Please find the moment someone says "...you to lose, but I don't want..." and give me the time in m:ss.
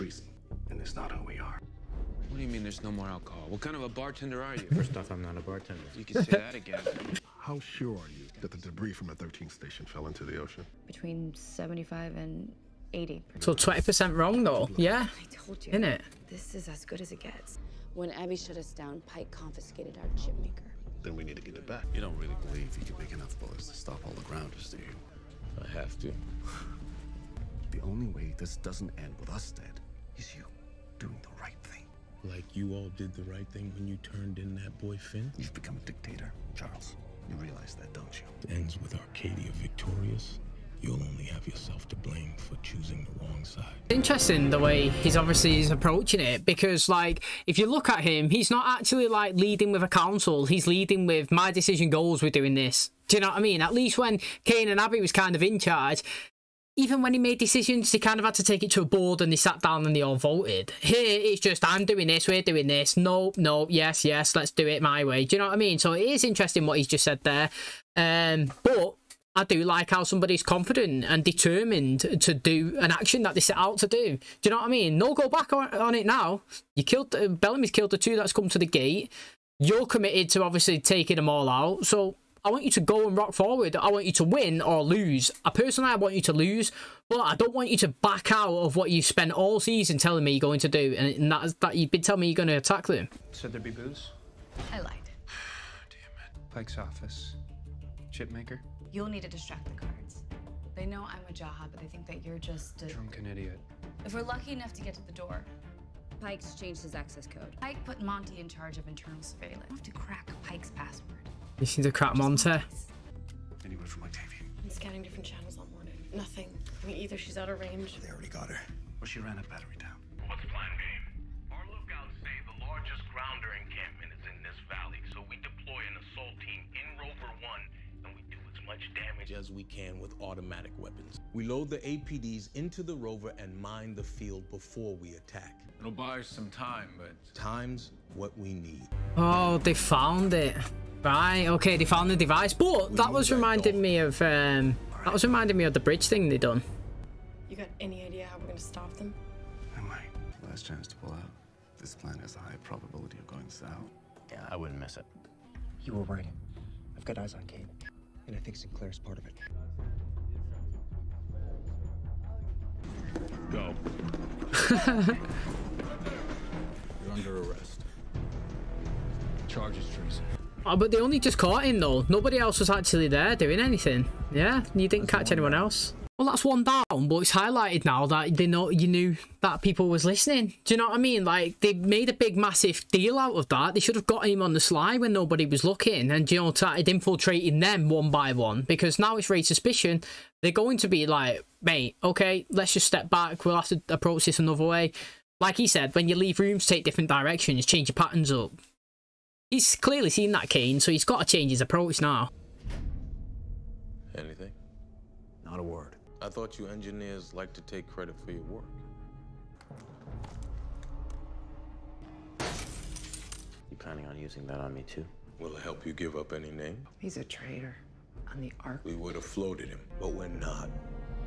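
1:26.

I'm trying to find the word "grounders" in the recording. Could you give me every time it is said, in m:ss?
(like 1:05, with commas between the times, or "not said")
0:24, 2:03.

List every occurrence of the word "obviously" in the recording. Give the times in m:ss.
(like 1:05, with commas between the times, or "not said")
0:45, 1:20.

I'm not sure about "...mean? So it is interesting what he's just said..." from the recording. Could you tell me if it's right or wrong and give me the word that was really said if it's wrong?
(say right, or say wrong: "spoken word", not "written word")
right.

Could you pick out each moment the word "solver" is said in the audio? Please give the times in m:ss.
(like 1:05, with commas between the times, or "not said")
not said.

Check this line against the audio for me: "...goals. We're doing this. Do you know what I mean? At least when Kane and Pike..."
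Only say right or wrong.
wrong.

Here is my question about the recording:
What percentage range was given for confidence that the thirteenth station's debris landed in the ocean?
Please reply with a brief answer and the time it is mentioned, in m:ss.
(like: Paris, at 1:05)
Between 75 and 80, at 0:10.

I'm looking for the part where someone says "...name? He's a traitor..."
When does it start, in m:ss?
3:36.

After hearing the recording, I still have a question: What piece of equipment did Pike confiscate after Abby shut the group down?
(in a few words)
Chip maker.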